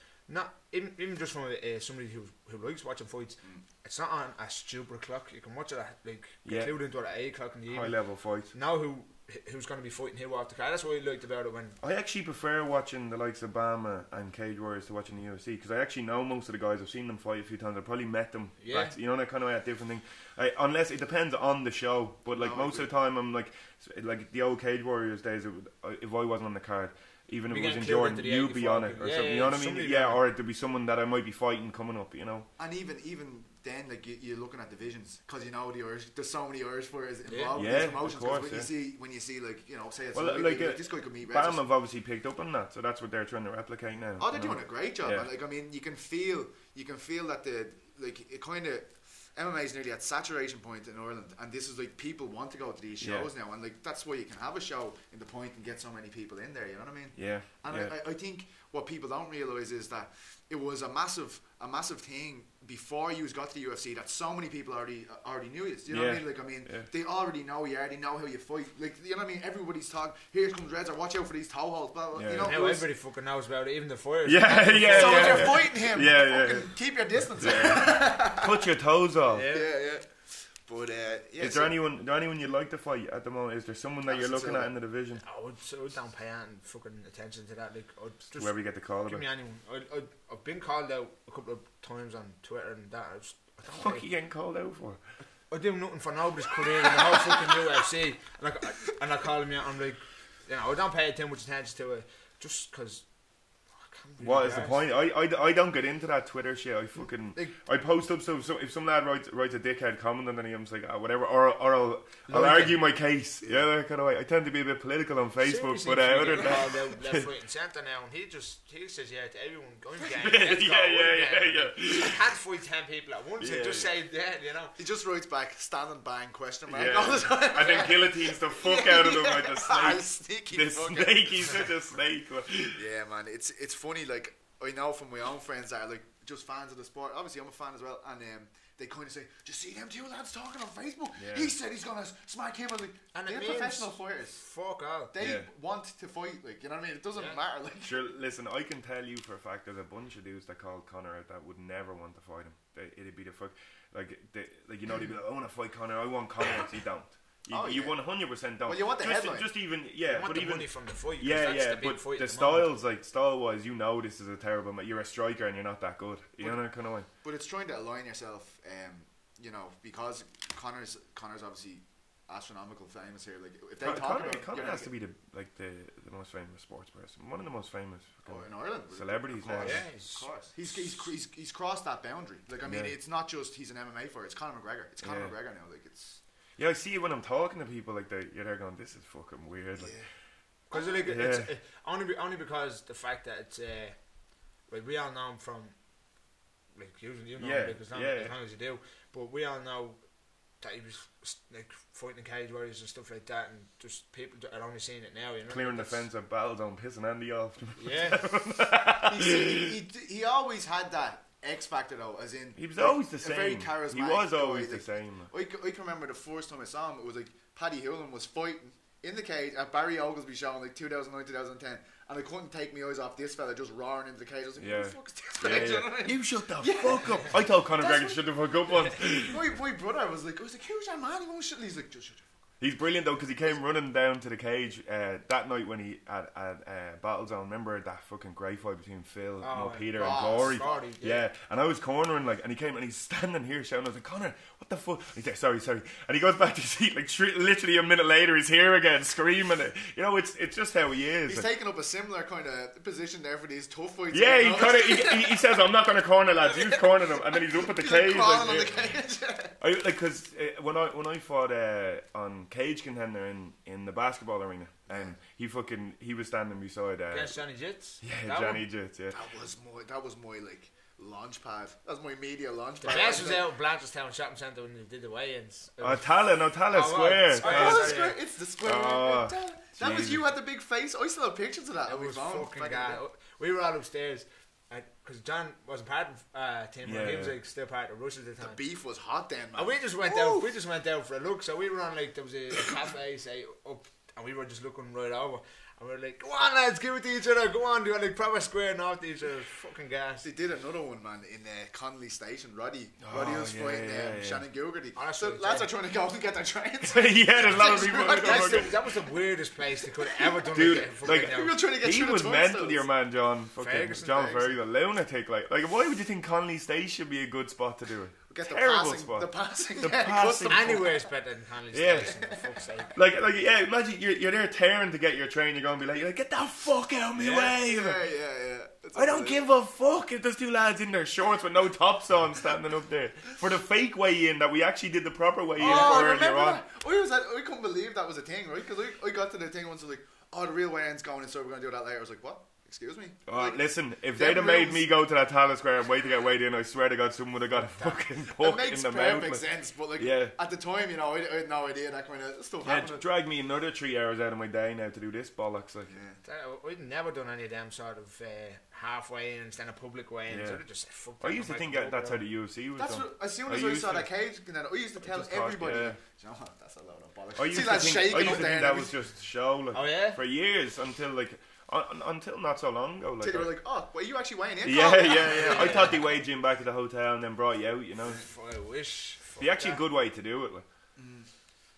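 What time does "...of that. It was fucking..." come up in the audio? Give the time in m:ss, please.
4:41.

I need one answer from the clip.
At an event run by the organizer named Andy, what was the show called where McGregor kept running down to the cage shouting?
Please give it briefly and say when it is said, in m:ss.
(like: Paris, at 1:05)
Battle Zone, at 3:26.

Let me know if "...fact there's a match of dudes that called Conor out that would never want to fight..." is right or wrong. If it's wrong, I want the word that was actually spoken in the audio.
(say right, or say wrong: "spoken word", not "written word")
wrong: "bunch", not "match".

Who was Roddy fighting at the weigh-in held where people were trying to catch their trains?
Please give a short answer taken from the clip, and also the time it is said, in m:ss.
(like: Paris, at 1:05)
Shannon Gilgerty, at 5:04.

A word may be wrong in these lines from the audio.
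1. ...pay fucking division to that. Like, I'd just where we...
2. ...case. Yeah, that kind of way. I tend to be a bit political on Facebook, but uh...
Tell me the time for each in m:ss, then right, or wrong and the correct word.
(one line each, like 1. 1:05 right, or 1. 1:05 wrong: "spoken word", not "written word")
1. 1:26 wrong: "attention", not "division"
2. 1:52 right.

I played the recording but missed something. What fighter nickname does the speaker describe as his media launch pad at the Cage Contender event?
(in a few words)
Johnny Jits.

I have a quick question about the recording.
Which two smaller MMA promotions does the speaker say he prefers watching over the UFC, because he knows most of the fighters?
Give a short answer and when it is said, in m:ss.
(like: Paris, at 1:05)
BAMMA and Cage Warriors, at 0:13.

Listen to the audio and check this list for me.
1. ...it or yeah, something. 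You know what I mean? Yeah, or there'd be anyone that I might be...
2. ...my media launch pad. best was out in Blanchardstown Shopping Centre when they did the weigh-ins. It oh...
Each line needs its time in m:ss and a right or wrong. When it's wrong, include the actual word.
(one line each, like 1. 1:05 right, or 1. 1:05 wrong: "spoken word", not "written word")
1. 0:28 wrong: "someone", not "anyone"
2. 4:32 right.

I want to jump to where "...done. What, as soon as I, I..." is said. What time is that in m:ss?
6:02.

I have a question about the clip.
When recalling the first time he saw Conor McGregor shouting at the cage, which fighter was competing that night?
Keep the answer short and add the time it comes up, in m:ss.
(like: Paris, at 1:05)
Paddy Holohan, at 3:37.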